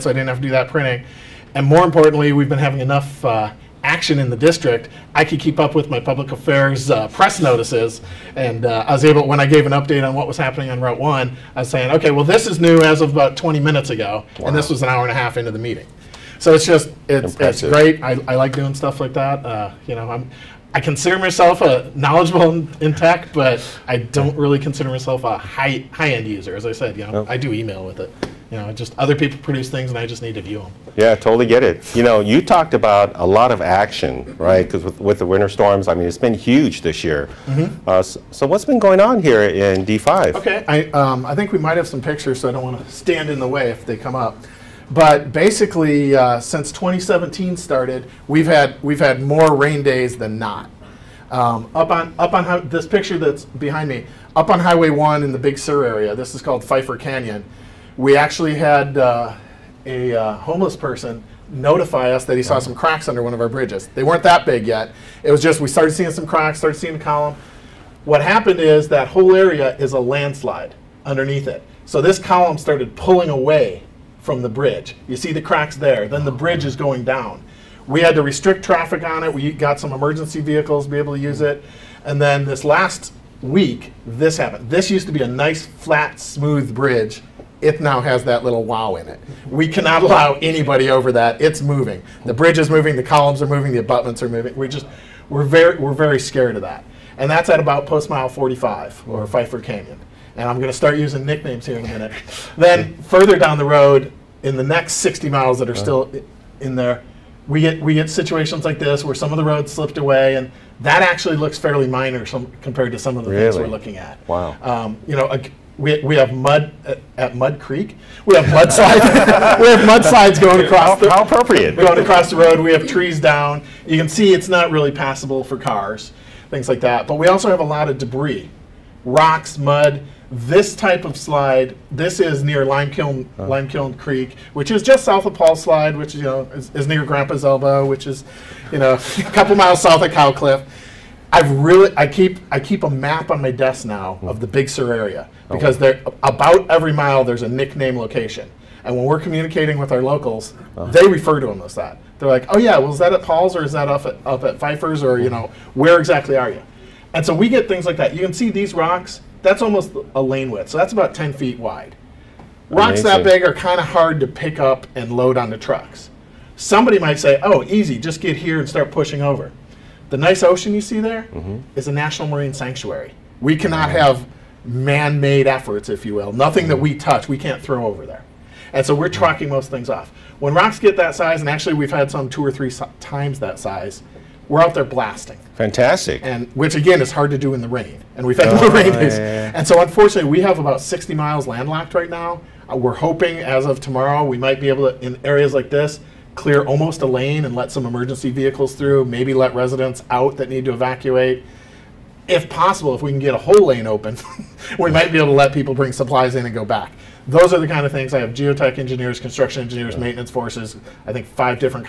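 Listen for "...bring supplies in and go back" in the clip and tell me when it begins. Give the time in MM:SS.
03:25.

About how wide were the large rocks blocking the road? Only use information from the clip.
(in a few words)
10 feet.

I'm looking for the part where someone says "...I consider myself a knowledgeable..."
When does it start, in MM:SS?
00:20.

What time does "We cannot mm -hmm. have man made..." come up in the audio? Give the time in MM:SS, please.
02:53.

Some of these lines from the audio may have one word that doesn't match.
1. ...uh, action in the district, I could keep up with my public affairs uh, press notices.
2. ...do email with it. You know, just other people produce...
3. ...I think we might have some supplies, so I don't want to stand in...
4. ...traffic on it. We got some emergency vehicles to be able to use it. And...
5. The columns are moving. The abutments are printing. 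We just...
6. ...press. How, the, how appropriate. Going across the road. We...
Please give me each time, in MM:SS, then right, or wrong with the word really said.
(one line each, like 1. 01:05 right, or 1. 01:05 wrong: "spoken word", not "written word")
1. 00:03 right
2. 00:27 right
3. 00:41 wrong: "pictures", not "supplies"
4. 01:18 right
5. 01:32 wrong: "moving", not "printing"
6. 02:00 wrong: "across", not "press".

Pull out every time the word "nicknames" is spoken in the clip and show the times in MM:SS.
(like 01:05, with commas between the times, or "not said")
01:41, 02:27.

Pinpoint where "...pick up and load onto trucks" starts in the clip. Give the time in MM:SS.
02:44.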